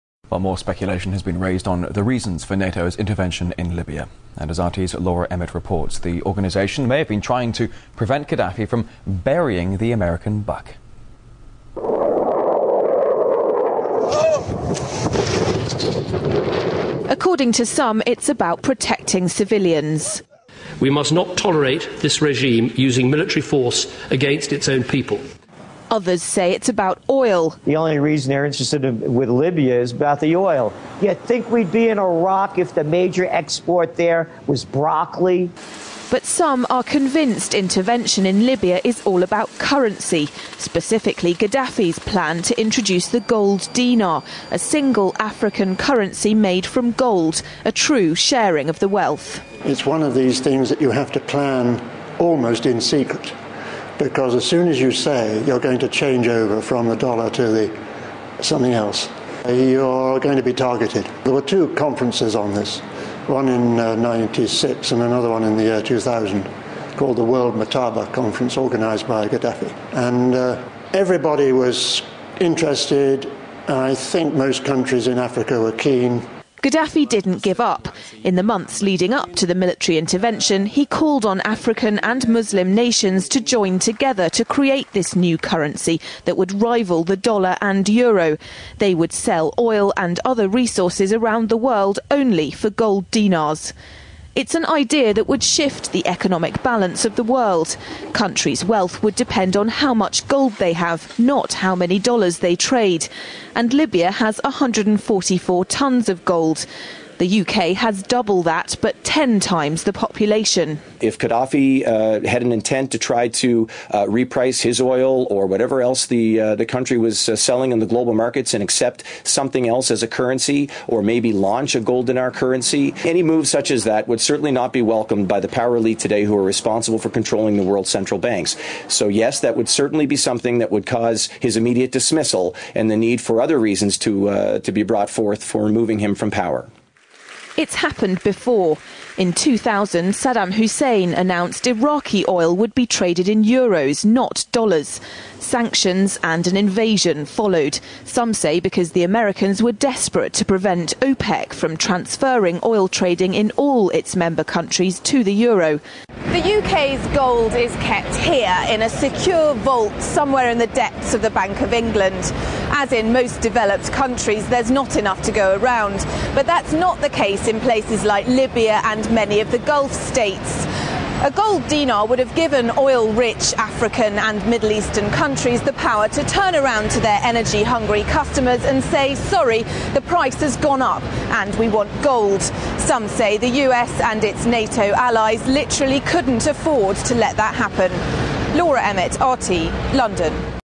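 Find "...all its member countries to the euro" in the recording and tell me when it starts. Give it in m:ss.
2:33.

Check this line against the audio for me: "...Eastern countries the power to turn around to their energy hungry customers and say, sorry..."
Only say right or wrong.
right.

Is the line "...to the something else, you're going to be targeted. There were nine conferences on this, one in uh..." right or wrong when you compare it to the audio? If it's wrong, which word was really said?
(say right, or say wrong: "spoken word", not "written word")
wrong: "two", not "nine".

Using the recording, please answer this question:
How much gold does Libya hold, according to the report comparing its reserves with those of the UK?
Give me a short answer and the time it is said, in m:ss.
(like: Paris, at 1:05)
144 tons, at 1:44.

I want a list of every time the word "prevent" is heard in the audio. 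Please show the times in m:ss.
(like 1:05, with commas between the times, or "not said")
0:07, 2:30.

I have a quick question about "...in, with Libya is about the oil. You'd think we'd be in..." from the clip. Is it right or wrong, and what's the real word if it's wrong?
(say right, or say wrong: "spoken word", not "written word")
right.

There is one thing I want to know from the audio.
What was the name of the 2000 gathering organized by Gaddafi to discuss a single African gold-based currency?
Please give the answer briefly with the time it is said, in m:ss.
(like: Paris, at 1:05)
World Mathaba Conference, at 1:07.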